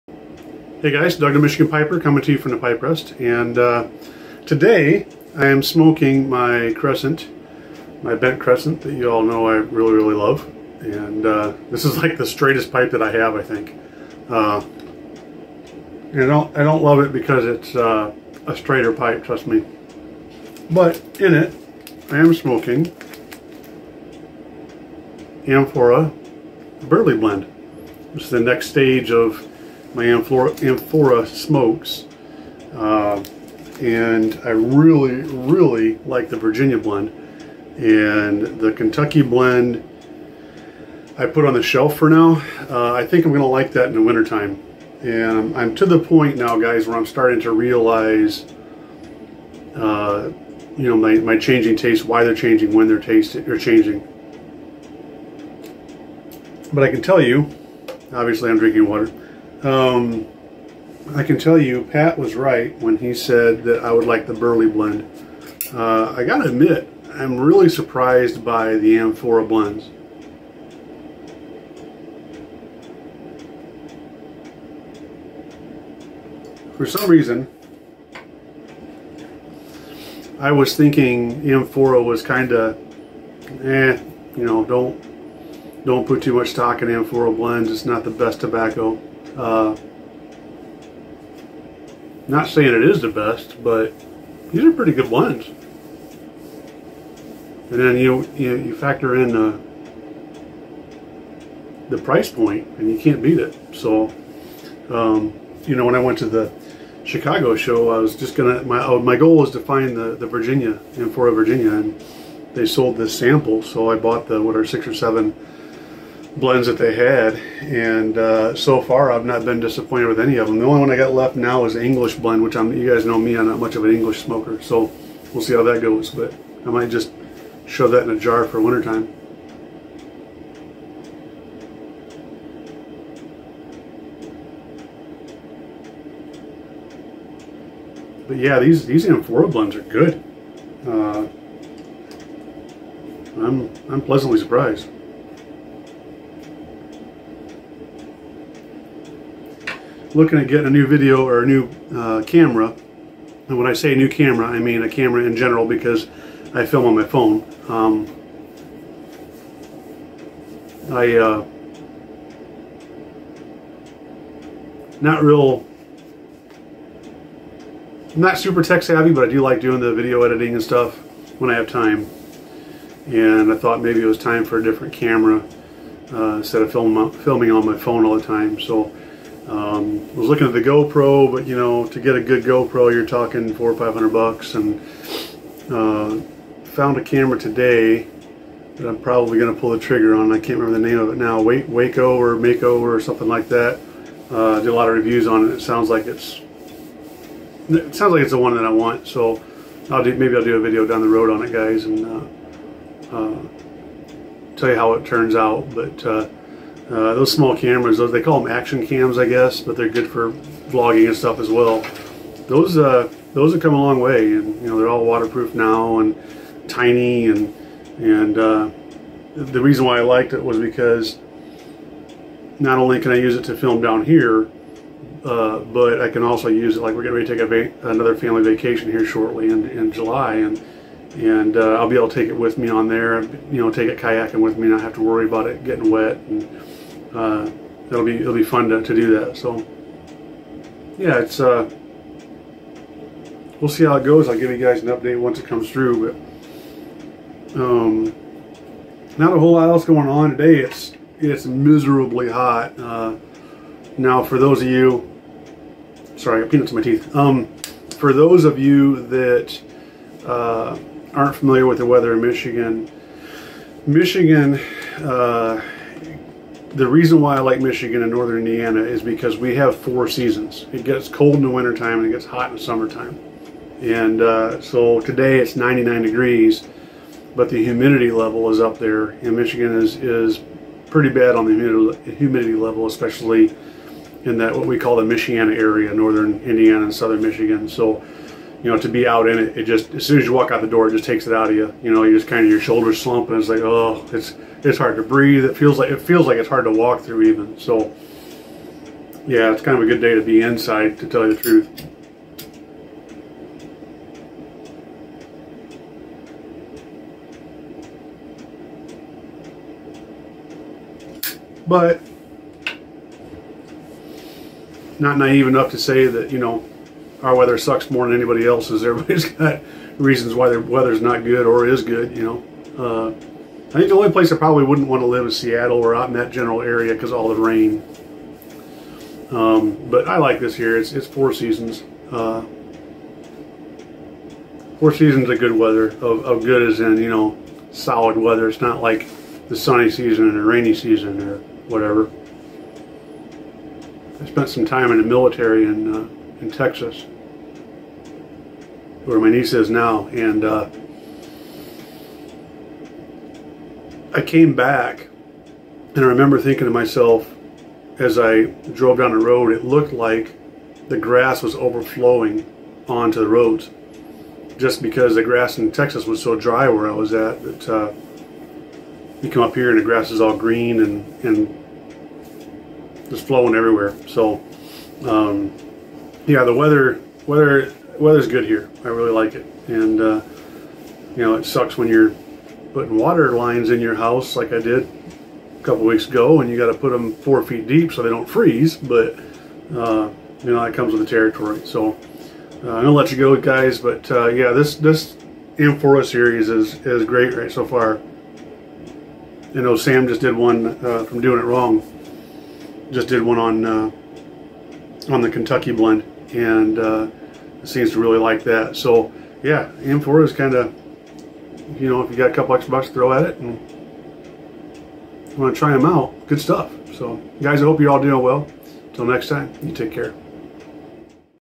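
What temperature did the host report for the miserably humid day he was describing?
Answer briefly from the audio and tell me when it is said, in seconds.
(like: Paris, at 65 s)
99 degrees, at 275 s.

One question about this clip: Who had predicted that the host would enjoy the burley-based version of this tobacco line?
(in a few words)
Pat.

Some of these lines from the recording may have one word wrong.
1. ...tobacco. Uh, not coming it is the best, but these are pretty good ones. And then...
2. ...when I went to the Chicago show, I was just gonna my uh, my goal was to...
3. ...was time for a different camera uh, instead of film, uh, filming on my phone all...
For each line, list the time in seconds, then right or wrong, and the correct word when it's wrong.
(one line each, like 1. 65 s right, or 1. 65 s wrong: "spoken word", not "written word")
1. 88 s wrong: "saying", not "coming"
2. 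105 s right
3. 174 s right.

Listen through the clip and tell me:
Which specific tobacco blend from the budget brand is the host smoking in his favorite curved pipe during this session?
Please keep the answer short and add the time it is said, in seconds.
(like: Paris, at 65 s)
Amphora Burley Blend, at 25 s.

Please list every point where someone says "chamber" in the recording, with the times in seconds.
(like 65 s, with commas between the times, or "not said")
not said.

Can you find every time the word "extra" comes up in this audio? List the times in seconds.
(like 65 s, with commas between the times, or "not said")
412 s.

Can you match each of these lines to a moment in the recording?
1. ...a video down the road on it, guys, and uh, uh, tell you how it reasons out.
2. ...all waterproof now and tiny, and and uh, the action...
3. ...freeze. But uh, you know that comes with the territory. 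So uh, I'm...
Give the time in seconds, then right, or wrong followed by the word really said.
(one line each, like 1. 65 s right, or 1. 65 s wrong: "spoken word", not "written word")
1. 200 s wrong: "turns", not "reasons"
2. 214 s wrong: "reason", not "action"
3. 388 s right.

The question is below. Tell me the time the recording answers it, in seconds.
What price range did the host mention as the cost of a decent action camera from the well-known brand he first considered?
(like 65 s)
183 s.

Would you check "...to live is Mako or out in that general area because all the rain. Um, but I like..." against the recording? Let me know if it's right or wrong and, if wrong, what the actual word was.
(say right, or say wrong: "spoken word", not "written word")
wrong: "Seattle", not "Mako".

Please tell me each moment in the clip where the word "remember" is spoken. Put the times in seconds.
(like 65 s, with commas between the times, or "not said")
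190 s, 356 s.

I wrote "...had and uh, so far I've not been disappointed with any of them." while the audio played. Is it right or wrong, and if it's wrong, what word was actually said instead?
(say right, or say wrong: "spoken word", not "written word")
right.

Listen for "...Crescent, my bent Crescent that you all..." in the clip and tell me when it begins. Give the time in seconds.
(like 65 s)
6 s.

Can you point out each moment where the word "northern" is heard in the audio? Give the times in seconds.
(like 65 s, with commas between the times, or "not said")
268 s, 285 s.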